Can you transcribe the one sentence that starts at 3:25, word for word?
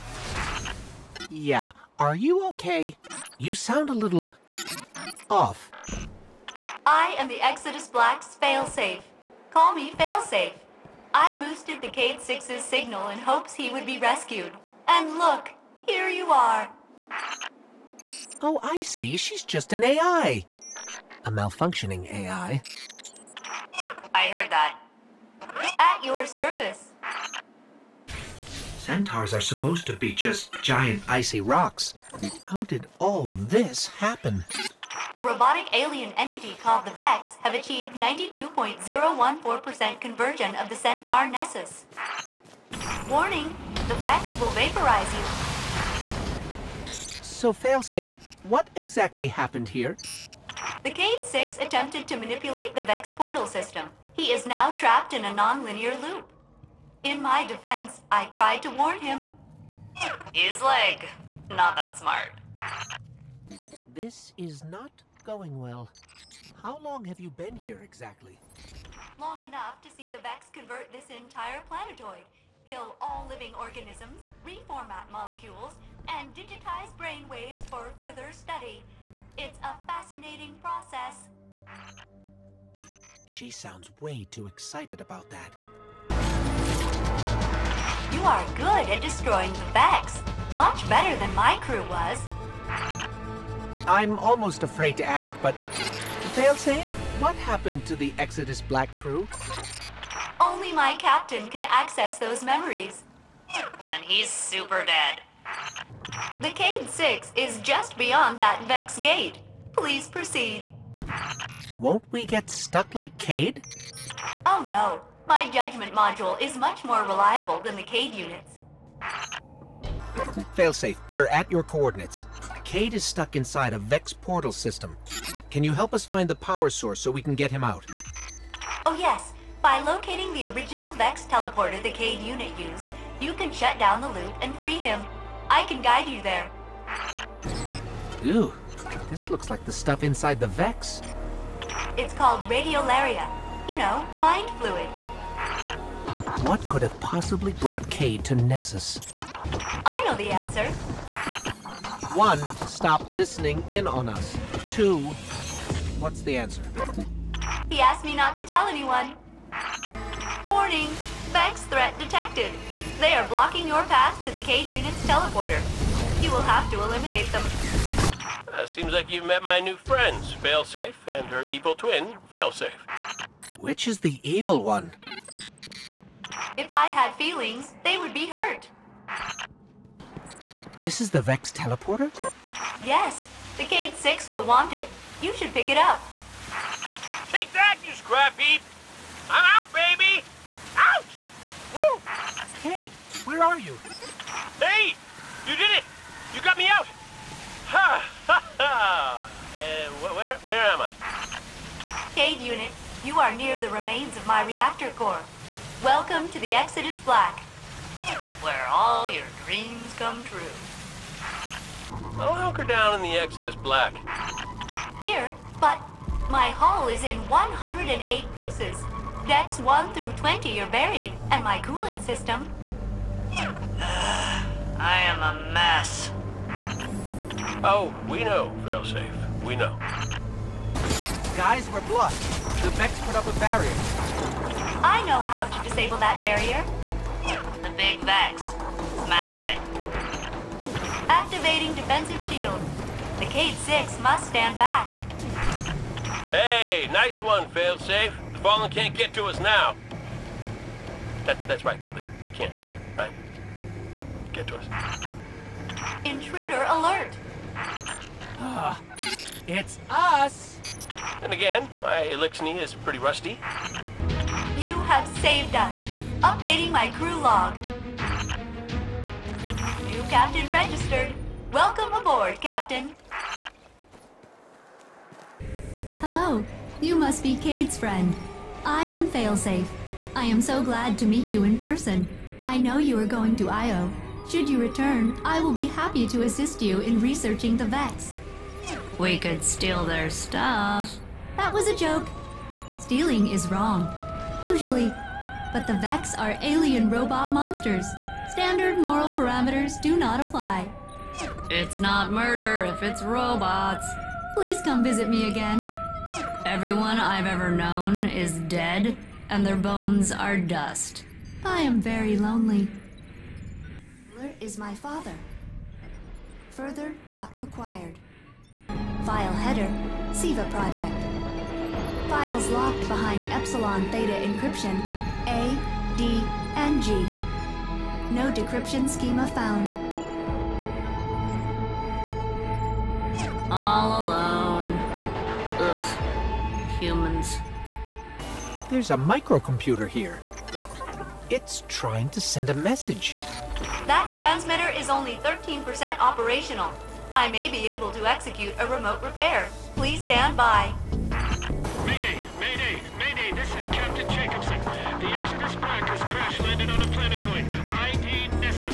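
Welcome to the Exodus Black, where all your dreams come true.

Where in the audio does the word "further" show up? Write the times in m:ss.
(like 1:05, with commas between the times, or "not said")
1:17, 5:16.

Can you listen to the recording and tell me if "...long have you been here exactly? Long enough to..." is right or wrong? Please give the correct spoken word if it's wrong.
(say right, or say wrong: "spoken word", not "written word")
right.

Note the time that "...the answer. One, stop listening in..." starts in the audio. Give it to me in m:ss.
2:30.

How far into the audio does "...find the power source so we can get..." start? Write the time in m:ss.
2:06.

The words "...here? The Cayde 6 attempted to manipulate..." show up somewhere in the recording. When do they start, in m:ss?
0:49.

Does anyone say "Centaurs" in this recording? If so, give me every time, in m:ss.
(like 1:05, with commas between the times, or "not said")
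0:28, 0:40.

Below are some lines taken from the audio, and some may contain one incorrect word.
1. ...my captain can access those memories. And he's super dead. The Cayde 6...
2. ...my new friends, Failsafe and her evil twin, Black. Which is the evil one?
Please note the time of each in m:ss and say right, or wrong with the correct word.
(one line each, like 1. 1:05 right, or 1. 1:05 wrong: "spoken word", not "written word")
1. 1:40 right
2. 2:49 wrong: "Failsafe", not "Black".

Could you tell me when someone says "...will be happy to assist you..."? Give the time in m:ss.
4:45.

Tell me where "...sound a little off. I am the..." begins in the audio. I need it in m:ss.
0:03.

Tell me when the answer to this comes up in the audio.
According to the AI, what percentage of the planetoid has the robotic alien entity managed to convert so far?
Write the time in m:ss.
0:37.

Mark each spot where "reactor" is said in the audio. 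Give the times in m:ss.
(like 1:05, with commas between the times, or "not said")
3:24.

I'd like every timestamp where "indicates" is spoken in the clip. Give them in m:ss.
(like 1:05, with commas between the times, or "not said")
not said.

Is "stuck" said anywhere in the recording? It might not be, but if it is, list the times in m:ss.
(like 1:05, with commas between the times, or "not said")
1:52, 2:03.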